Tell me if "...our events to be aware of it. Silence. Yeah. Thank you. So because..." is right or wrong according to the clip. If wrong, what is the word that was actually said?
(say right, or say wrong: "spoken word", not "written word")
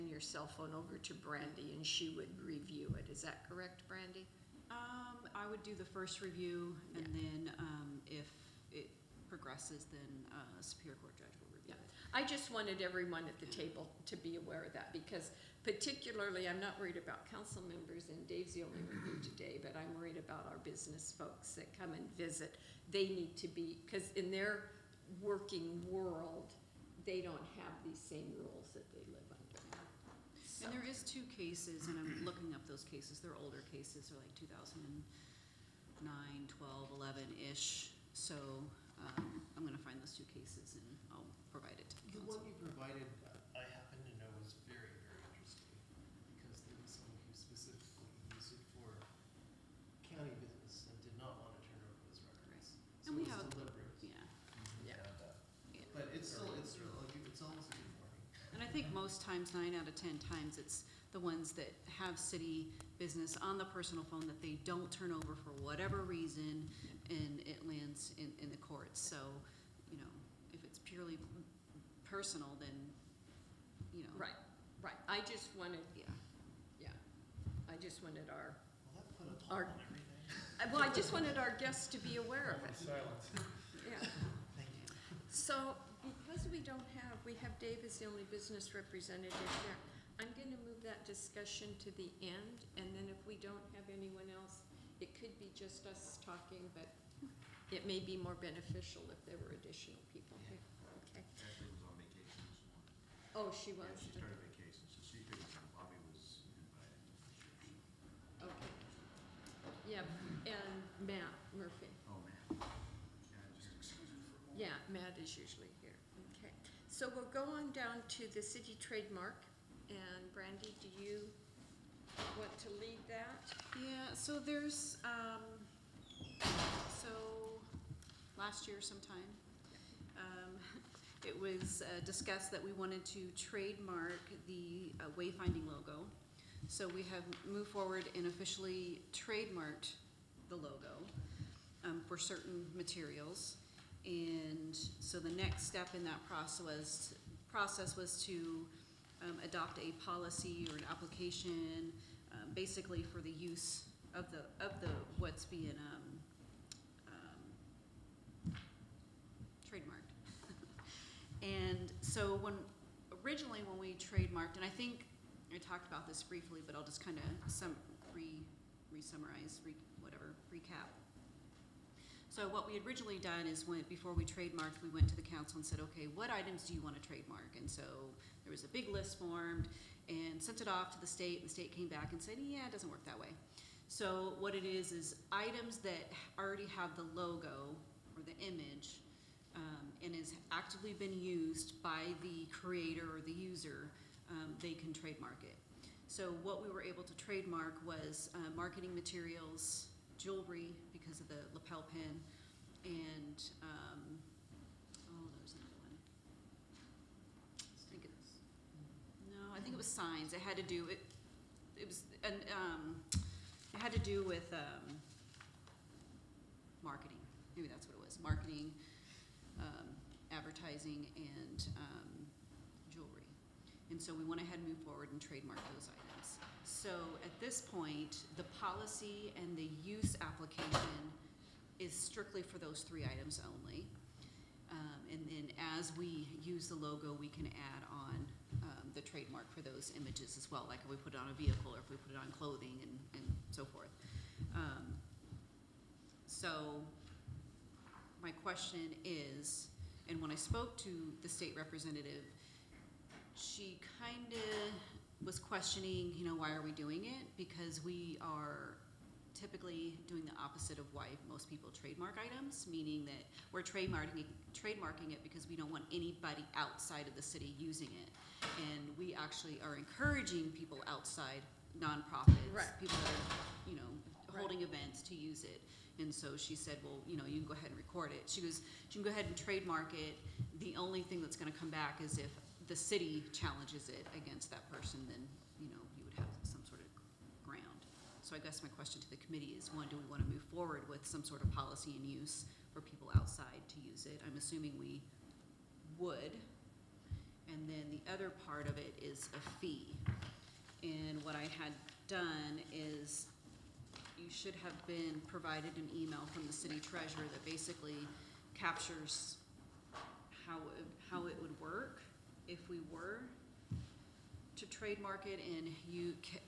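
wrong: "guests", not "events".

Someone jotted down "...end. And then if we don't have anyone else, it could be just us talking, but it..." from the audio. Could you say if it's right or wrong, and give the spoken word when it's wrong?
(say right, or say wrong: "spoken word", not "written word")
right.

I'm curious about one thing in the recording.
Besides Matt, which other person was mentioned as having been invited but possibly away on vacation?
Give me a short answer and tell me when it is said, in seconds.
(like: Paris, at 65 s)
Bobby, at 105 s.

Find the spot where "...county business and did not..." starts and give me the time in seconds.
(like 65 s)
50 s.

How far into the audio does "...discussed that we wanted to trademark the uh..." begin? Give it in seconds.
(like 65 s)
132 s.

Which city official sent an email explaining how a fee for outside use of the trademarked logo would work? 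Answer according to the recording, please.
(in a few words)
city treasurer.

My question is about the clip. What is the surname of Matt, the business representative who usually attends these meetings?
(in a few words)
Murphy.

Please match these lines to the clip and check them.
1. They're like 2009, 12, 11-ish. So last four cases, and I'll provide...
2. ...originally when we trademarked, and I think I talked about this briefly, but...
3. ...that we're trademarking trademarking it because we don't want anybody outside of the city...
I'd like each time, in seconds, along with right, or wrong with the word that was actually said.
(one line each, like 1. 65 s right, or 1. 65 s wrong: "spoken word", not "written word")
1. 34 s wrong: "two", not "four"
2. 163 s right
3. 263 s right.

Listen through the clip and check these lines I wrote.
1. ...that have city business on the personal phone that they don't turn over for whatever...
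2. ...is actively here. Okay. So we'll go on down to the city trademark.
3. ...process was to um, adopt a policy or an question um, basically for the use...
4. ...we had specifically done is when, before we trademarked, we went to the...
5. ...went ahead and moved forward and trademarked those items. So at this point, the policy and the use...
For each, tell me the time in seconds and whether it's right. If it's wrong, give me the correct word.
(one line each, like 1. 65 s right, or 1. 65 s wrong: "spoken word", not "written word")
1. 61 s right
2. 115 s wrong: "usually", not "actively"
3. 147 s wrong: "application", not "question"
4. 172 s wrong: "originally", not "specifically"
5. 224 s right.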